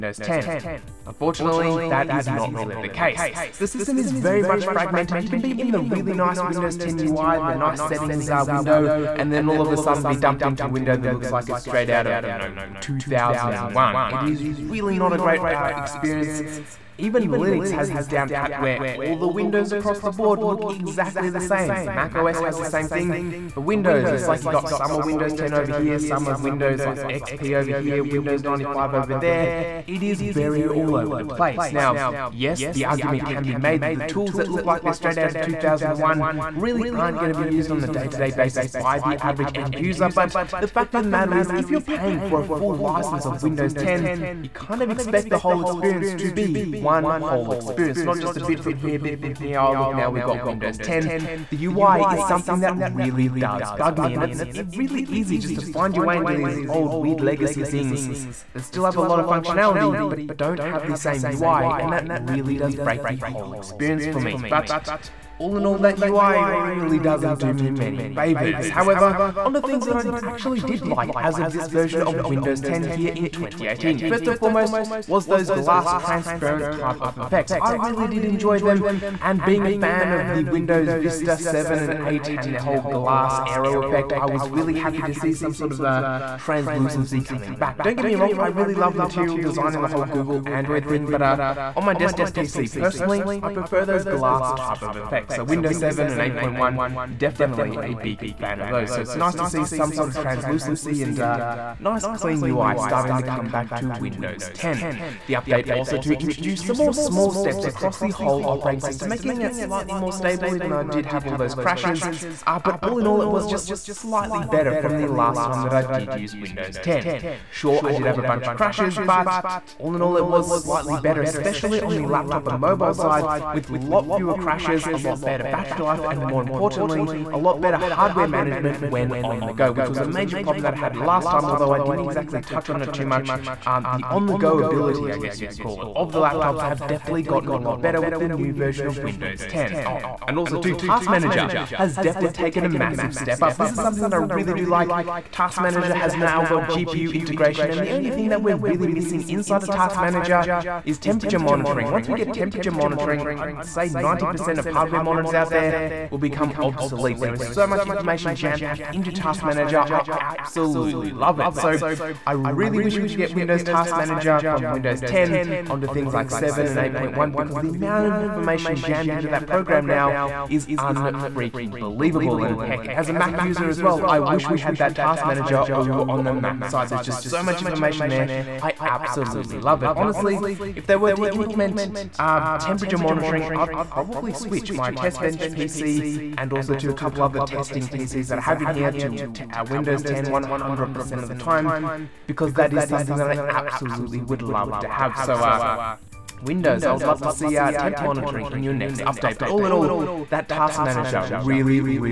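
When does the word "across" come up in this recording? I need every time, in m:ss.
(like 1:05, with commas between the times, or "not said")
0:19, 1:47.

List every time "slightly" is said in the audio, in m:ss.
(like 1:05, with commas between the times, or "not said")
1:49, 1:53, 2:00.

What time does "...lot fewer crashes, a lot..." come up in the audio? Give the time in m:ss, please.
2:03.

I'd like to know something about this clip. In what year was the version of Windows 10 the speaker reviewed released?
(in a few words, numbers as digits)
2018.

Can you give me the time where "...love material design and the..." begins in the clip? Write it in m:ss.
1:28.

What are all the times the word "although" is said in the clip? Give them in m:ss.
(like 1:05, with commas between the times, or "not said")
2:11.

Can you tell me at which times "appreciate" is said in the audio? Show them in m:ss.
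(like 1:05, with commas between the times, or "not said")
not said.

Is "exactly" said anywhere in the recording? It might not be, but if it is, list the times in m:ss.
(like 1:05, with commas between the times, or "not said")
0:20, 2:11.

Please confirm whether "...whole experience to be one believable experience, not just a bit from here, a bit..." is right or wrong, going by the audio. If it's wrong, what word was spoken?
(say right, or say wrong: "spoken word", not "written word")
wrong: "whole", not "believable".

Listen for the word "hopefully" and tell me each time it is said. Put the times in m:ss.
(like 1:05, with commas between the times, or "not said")
not said.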